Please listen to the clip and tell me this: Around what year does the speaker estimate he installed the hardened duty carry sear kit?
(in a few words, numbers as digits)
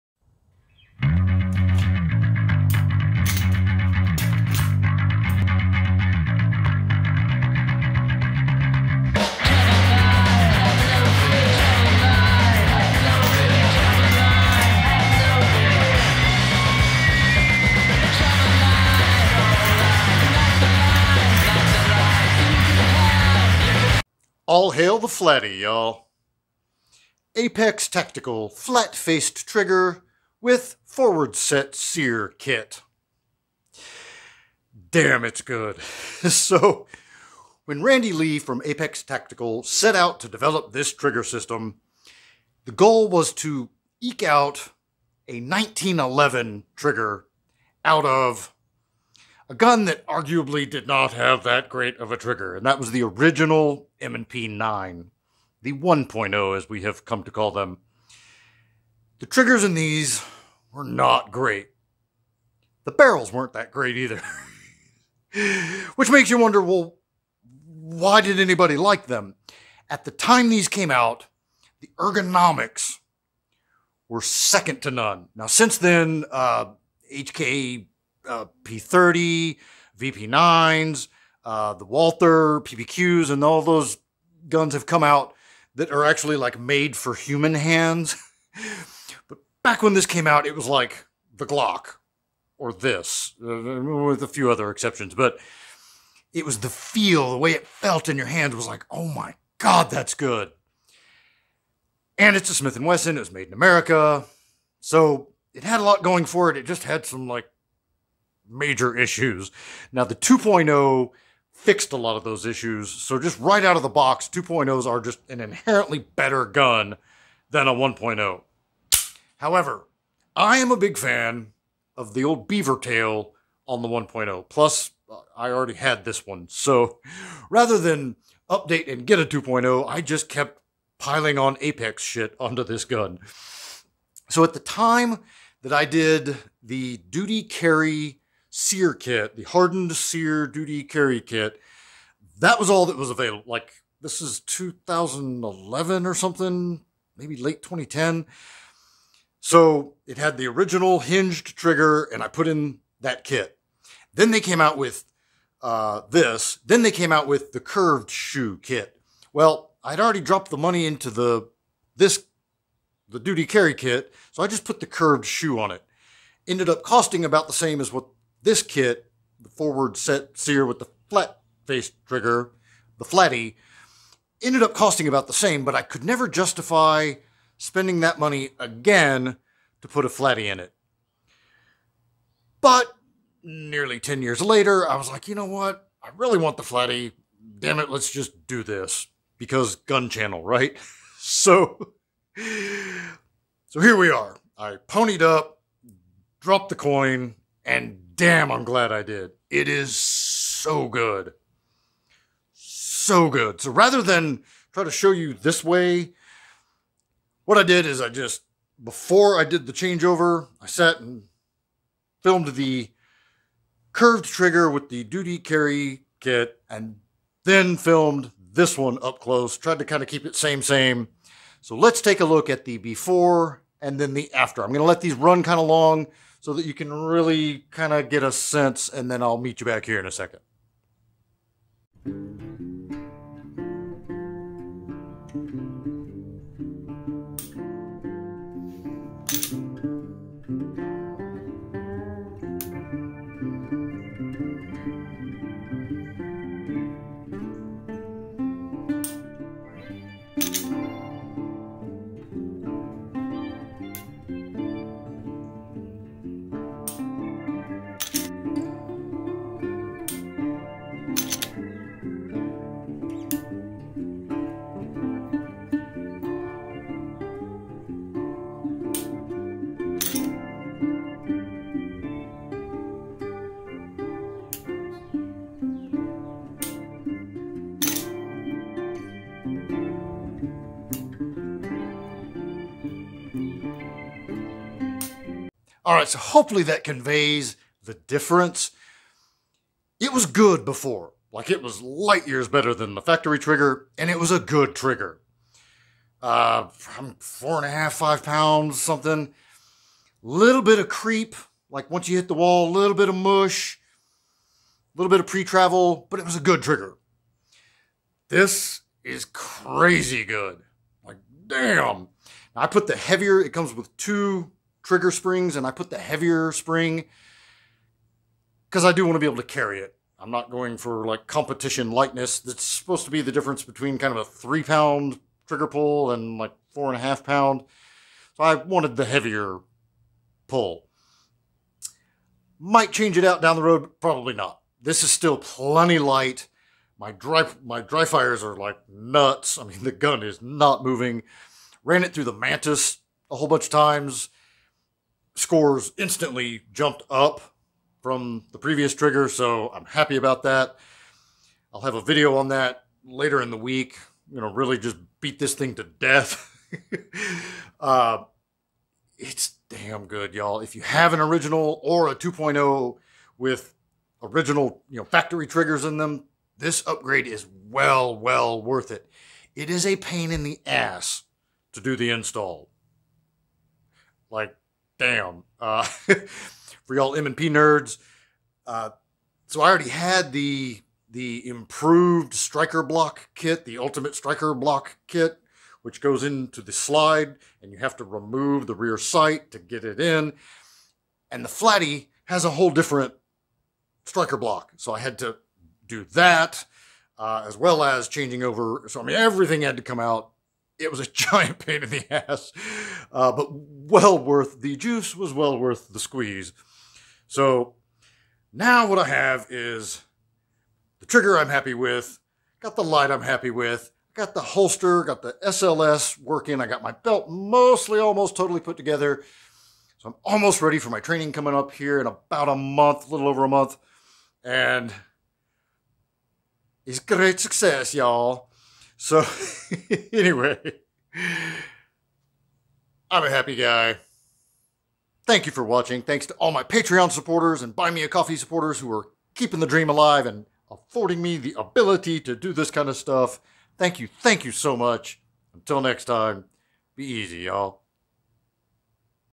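2011.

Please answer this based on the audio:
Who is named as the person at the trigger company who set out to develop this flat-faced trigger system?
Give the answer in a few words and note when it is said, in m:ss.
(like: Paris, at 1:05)
Randy Lee, at 0:37.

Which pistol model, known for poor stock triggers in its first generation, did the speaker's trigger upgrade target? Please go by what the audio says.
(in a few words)
M&P 9.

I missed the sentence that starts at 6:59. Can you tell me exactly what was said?
So I'm almost ready for my training coming up here in about a month, a little over a month.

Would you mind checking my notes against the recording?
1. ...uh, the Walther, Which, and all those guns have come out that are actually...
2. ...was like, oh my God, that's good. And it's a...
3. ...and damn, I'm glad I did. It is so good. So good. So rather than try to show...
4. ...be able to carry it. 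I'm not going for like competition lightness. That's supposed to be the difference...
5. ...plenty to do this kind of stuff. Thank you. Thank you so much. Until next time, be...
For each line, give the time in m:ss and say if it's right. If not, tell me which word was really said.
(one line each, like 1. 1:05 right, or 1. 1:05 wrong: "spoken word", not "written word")
1. 1:21 wrong: "PPQs", not "Which"
2. 1:38 right
3. 3:17 right
4. 5:19 right
5. 7:21 wrong: "ability", not "plenty".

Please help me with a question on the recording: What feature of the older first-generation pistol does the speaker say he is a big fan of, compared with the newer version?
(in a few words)
beaver tail.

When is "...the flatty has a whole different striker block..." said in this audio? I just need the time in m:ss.
6:31.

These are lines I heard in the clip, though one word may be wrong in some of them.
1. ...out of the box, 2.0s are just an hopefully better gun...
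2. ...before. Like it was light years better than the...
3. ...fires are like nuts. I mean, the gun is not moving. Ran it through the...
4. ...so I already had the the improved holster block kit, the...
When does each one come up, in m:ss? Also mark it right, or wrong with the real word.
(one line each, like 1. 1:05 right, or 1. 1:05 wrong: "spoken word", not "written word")
1. 1:53 wrong: "inherently", not "hopefully"
2. 4:50 right
3. 5:38 right
4. 6:19 wrong: "striker", not "holster".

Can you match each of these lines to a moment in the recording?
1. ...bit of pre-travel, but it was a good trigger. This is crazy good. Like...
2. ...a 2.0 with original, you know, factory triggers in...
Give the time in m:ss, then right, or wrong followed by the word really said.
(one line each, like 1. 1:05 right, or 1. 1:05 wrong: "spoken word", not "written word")
1. 5:05 right
2. 6:02 right.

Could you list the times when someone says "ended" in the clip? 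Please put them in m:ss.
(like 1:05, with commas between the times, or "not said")
2:46, 2:54.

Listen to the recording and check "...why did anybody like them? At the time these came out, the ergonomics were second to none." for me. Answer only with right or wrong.
right.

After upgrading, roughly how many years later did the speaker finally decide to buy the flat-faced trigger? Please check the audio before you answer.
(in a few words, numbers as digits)
10 years.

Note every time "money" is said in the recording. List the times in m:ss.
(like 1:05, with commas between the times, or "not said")
2:40, 2:58.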